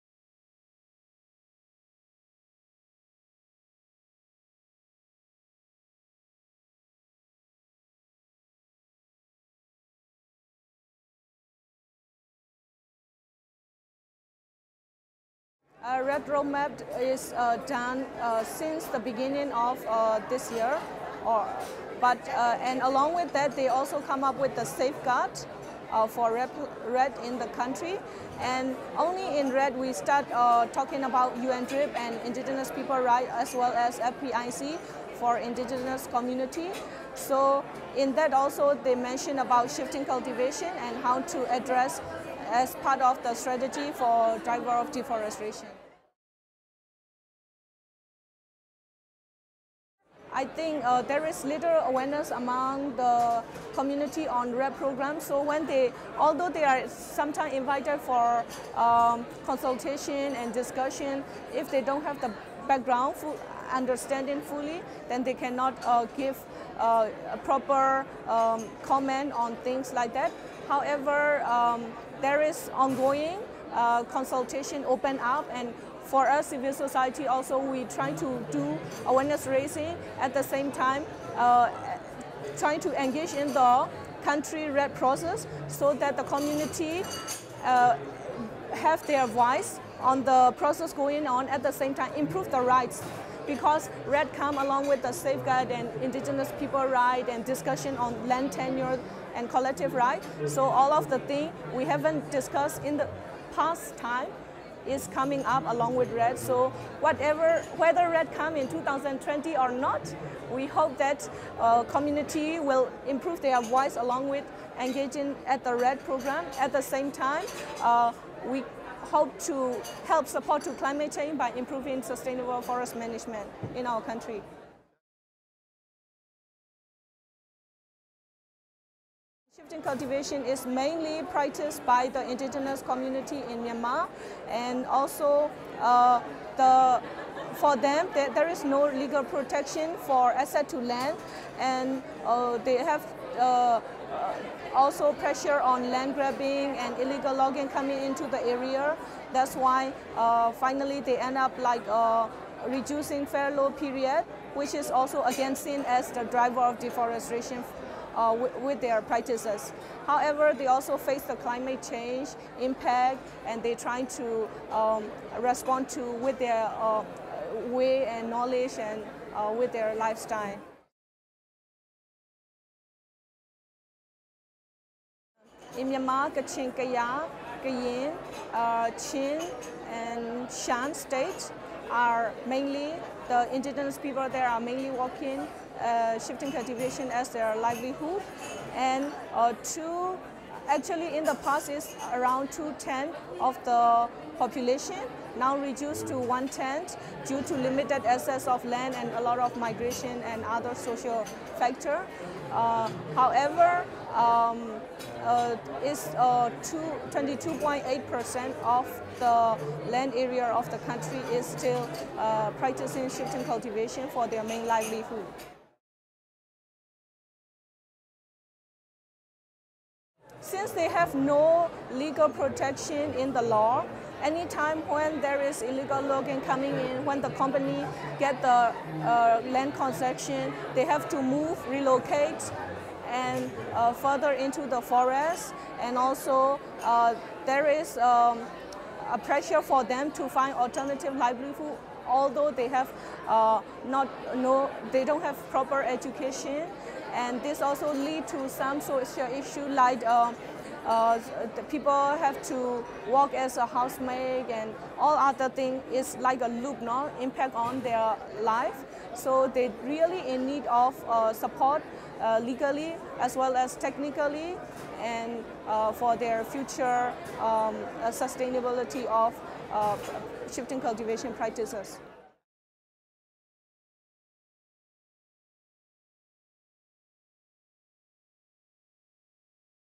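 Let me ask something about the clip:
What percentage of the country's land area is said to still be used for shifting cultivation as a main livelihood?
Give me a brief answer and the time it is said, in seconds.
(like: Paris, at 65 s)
22.8%, at 206 s.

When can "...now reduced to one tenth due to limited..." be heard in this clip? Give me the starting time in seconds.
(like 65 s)
195 s.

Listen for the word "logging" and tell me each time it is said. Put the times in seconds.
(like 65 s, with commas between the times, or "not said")
147 s, 226 s.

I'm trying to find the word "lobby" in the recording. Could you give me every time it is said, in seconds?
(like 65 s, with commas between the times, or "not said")
not said.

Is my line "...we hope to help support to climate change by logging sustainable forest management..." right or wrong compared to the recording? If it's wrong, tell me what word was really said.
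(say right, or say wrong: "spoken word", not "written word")
wrong: "improving", not "logging".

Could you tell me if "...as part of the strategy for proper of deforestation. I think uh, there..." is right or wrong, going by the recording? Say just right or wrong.
wrong.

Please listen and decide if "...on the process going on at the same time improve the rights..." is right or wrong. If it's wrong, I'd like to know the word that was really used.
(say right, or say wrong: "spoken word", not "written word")
right.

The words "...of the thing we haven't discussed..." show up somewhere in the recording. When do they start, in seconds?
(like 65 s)
100 s.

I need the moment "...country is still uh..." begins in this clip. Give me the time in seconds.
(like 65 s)
210 s.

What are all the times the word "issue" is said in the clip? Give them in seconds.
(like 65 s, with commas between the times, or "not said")
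249 s.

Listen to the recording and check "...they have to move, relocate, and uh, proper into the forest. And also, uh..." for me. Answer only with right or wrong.
wrong.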